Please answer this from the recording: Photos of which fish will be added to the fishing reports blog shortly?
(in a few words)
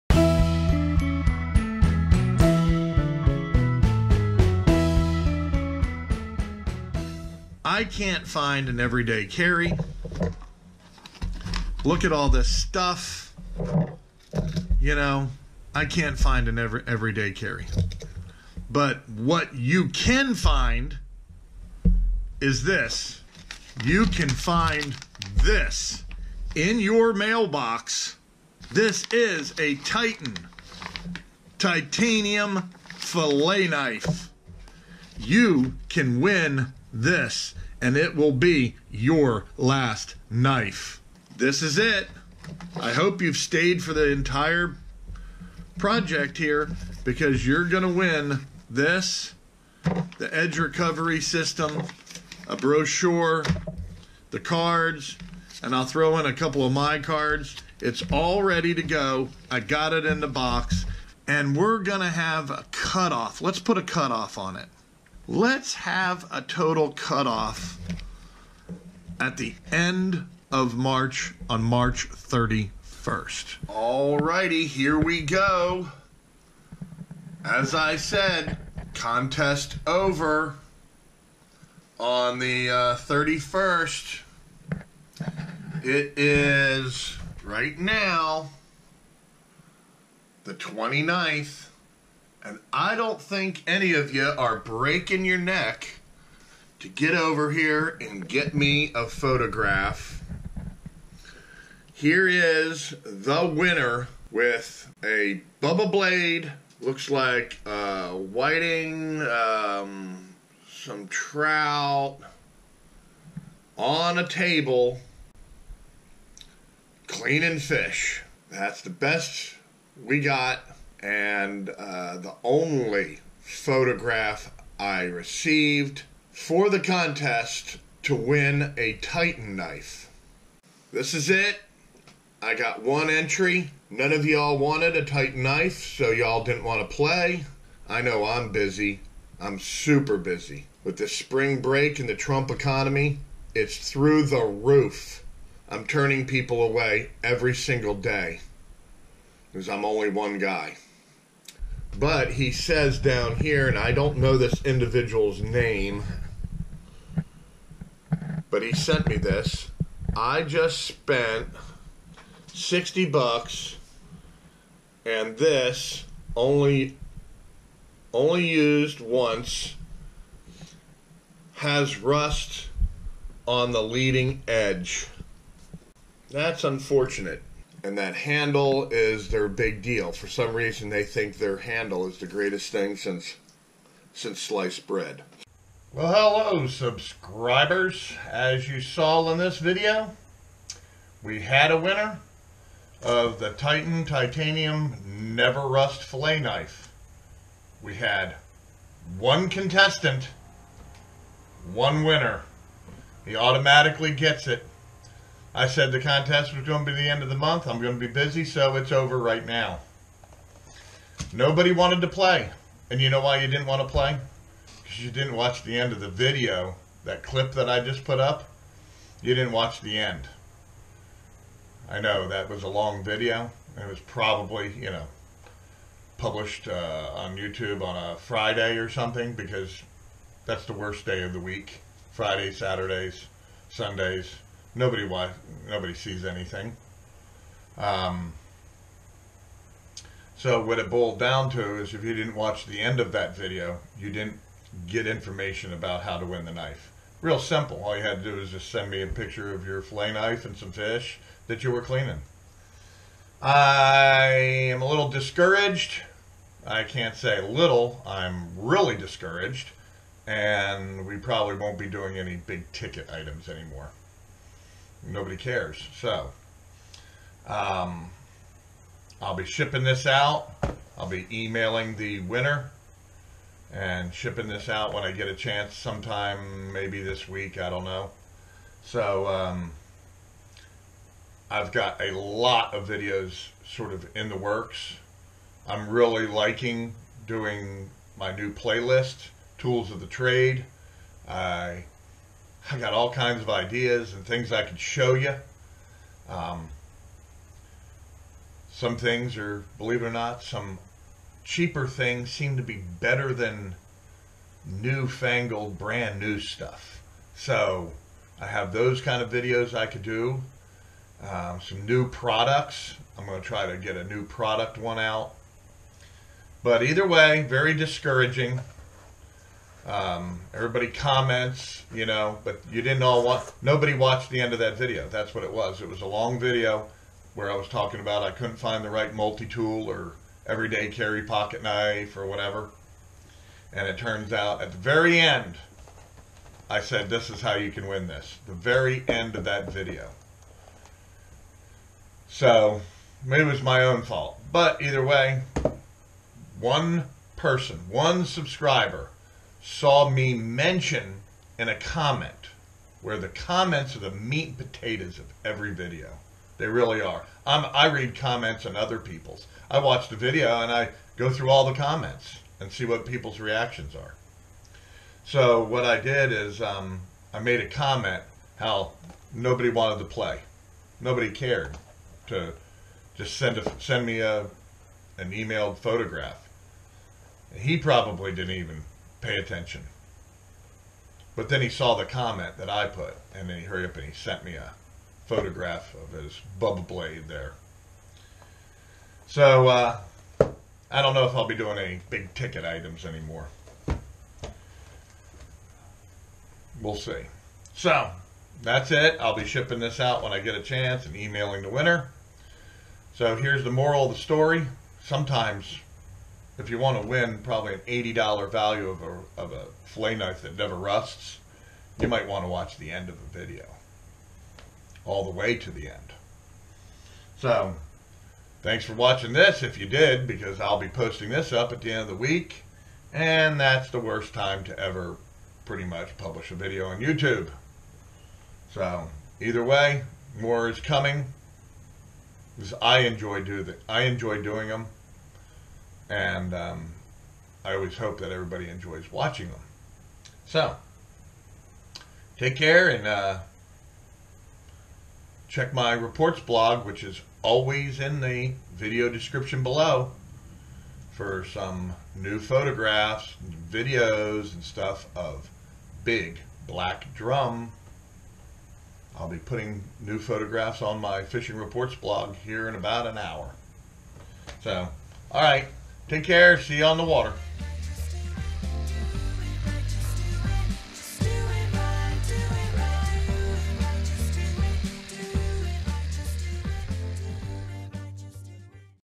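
Big Black Drum.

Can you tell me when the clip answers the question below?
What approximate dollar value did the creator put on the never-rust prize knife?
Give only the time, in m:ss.
6:47.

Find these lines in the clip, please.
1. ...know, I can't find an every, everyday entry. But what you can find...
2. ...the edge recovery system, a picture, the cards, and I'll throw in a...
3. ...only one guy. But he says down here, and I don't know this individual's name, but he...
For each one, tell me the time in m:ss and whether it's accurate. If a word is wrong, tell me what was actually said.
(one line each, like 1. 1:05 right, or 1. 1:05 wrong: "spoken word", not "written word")
1. 0:14 wrong: "carry", not "entry"
2. 0:50 wrong: "brochure", not "picture"
3. 2:29 right.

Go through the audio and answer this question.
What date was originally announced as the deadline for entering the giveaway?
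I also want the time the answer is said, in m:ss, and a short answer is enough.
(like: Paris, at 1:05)
March 31, at 1:11.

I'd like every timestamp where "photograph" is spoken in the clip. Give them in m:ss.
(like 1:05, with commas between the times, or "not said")
1:39, 2:03, 6:15, 6:25, 7:32, 7:40.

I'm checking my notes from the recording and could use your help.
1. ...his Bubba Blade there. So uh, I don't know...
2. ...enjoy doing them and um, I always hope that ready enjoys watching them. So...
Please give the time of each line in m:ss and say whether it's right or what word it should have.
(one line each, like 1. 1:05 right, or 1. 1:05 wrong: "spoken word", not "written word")
1. 6:26 right
2. 7:14 wrong: "everybody", not "ready".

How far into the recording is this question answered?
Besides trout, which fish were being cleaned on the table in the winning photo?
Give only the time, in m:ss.
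1:48.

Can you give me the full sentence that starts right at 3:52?
Fridays, Saturdays, Sundays, nobody watch, nobody sees anything.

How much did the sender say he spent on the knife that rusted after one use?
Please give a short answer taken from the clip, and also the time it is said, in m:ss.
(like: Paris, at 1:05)
$60, at 2:42.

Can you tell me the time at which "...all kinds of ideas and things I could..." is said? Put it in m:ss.
4:52.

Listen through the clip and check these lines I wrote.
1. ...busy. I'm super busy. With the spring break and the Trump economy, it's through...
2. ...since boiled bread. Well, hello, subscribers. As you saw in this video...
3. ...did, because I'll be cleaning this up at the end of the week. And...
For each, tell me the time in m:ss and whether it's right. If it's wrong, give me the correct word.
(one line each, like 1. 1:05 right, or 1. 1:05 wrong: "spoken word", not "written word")
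1. 2:18 right
2. 3:04 wrong: "sliced", not "boiled"
3. 6:59 wrong: "posting", not "cleaning".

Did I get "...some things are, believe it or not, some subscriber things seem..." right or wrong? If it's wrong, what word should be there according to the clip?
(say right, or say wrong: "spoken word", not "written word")
wrong: "cheaper", not "subscriber".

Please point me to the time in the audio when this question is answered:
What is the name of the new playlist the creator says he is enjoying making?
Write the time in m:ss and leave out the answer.
4:49.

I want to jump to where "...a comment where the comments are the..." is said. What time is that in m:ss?
5:51.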